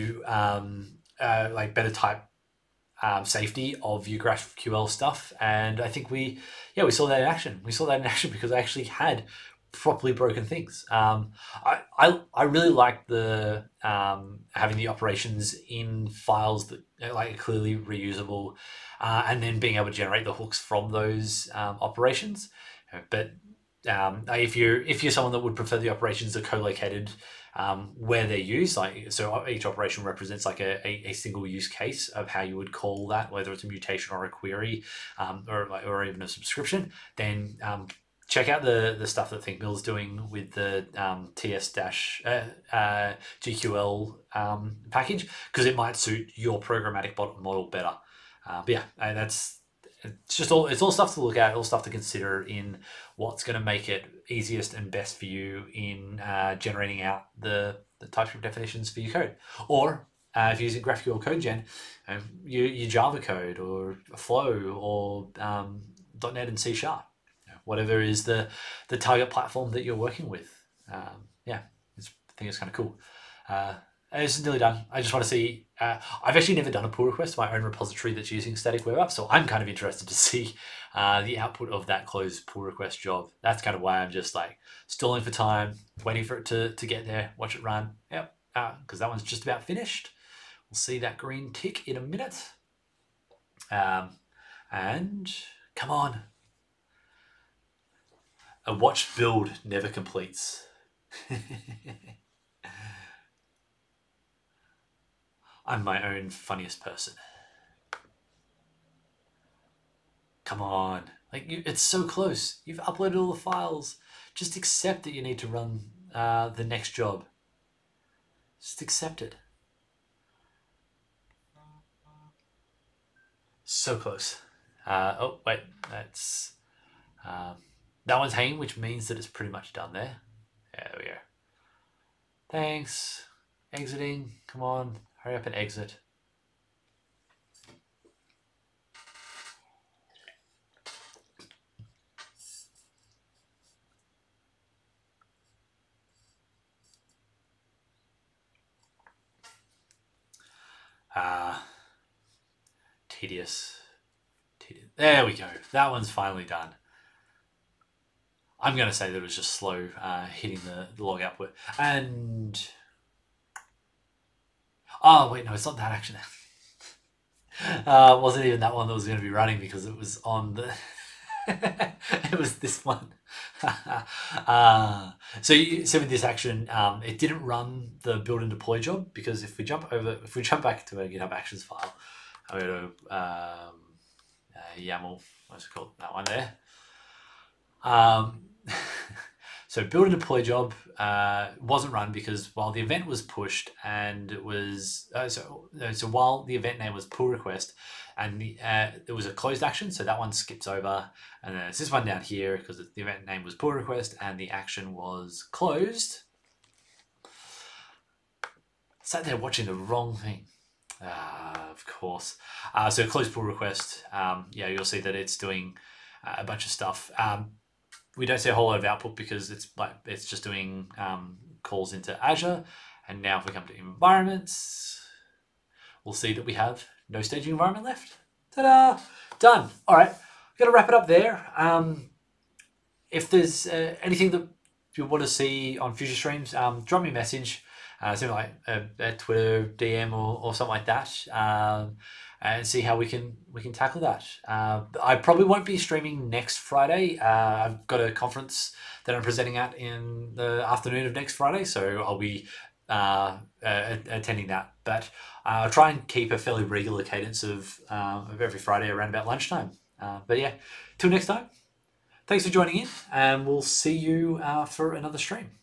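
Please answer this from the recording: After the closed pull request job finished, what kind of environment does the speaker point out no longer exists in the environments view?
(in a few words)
staging environment.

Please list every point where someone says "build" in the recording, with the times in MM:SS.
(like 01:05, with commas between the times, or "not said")
01:39, 02:58, 03:09.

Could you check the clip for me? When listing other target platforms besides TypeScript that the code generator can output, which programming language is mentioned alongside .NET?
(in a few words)
C#.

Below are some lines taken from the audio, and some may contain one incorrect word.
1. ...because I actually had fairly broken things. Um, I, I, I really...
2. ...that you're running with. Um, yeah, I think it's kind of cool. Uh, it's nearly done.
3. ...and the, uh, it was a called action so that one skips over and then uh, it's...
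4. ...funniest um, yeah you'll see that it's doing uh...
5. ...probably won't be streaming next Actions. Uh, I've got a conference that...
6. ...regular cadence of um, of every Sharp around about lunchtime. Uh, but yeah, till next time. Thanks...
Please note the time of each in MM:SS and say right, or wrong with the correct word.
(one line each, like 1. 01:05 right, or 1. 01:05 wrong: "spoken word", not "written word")
1. 00:08 wrong: "properly", not "fairly"
2. 01:09 wrong: "working", not "running"
3. 03:18 wrong: "closed", not "called"
4. 03:33 wrong: "request", not "funniest"
5. 04:05 wrong: "Friday", not "Actions"
6. 04:16 wrong: "Friday", not "Sharp".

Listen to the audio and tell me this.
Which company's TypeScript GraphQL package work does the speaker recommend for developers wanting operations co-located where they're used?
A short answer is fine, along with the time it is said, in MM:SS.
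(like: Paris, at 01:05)
Thinkmill, at 00:39.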